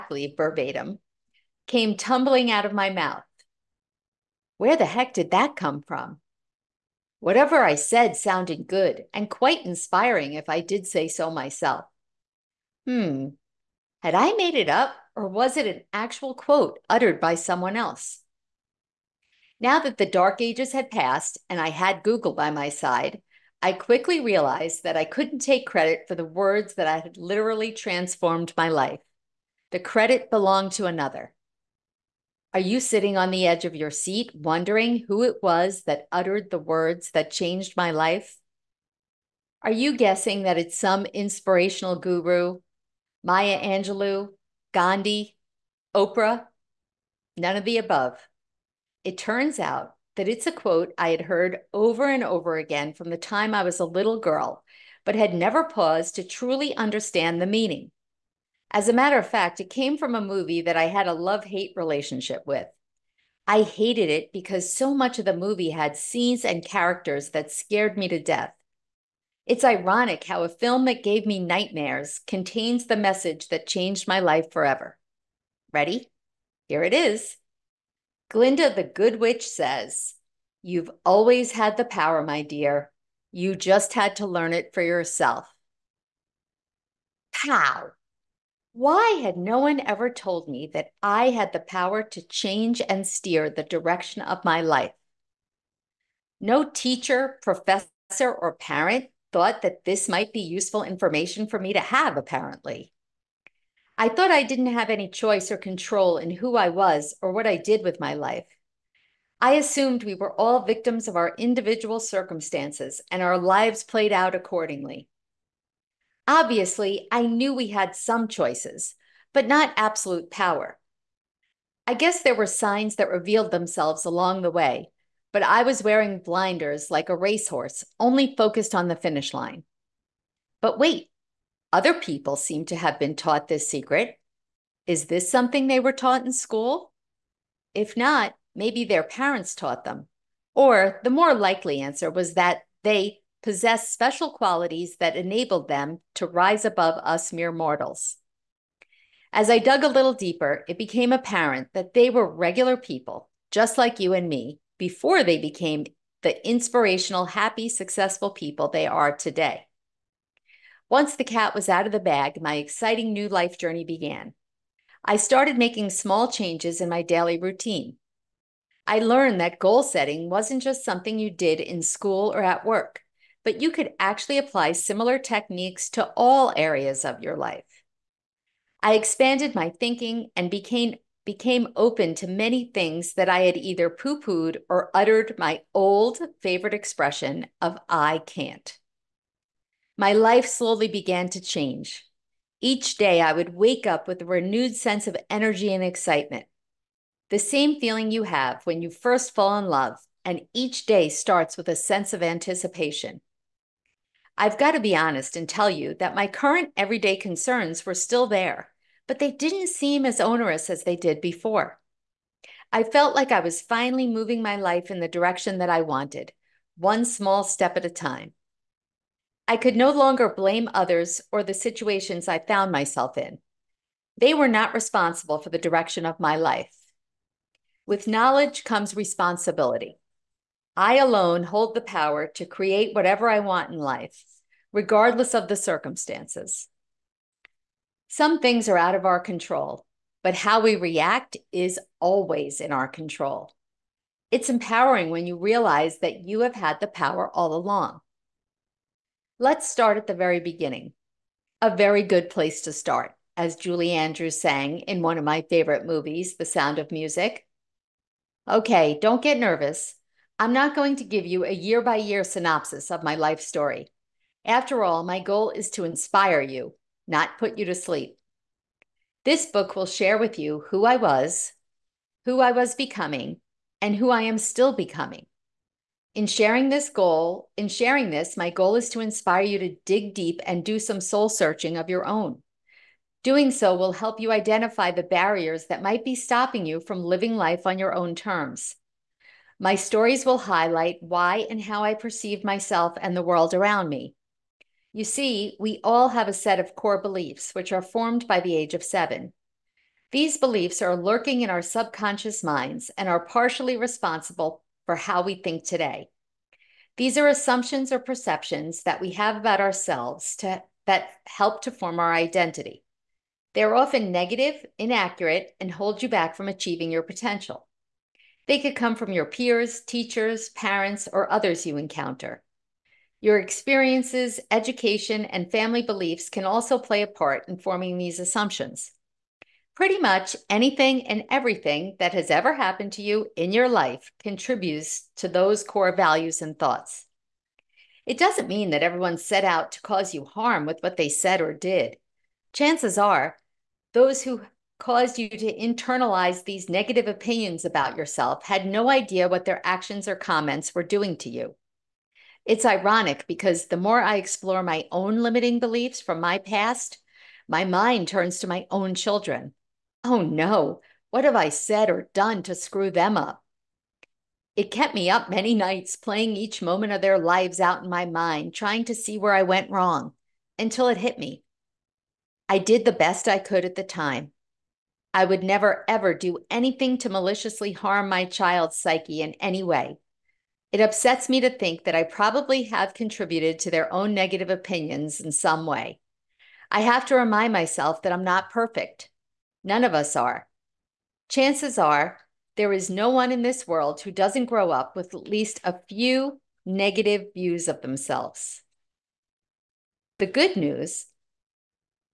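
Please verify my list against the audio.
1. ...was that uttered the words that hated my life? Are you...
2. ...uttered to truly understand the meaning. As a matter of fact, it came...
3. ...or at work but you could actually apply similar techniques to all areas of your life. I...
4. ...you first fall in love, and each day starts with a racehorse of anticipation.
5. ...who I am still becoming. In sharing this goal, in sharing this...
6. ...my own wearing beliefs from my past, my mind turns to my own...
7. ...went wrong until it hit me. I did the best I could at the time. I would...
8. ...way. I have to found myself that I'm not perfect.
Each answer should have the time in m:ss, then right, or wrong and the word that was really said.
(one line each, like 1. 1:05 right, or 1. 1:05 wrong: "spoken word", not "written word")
1. 0:35 wrong: "changed", not "hated"
2. 0:55 wrong: "paused", not "uttered"
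3. 2:52 right
4. 3:18 wrong: "sense", not "racehorse"
5. 4:33 right
6. 5:54 wrong: "limiting", not "wearing"
7. 6:09 right
8. 6:25 wrong: "remind", not "found".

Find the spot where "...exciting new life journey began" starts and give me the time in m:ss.
2:42.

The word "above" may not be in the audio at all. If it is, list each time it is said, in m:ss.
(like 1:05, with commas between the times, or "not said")
0:47, 2:26.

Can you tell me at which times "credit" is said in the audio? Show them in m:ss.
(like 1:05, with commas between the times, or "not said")
0:25, 0:29.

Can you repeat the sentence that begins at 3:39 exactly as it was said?
I could no longer blame others or the situations I found myself in.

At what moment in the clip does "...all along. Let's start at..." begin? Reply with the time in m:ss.
4:07.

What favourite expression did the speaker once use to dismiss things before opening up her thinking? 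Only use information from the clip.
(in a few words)
I can't.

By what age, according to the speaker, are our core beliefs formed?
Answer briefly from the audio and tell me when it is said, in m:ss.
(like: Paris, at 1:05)
7, at 4:58.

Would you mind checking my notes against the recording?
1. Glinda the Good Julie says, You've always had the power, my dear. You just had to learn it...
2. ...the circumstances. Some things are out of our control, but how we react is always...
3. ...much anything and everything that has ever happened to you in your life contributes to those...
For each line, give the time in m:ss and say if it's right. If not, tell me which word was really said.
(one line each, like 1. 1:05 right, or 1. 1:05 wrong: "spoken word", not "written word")
1. 1:18 wrong: "Witch", not "Julie"
2. 3:55 right
3. 5:29 right.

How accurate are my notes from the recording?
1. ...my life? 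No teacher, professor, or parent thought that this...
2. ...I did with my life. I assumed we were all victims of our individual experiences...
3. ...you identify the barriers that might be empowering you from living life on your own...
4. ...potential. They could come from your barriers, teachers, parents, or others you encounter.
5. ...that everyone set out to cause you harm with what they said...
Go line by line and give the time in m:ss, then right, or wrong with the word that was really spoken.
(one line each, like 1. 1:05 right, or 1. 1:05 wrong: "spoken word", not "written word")
1. 1:34 right
2. 1:47 wrong: "circumstances", not "experiences"
3. 4:44 wrong: "stopping", not "empowering"
4. 5:17 wrong: "peers", not "barriers"
5. 5:38 right.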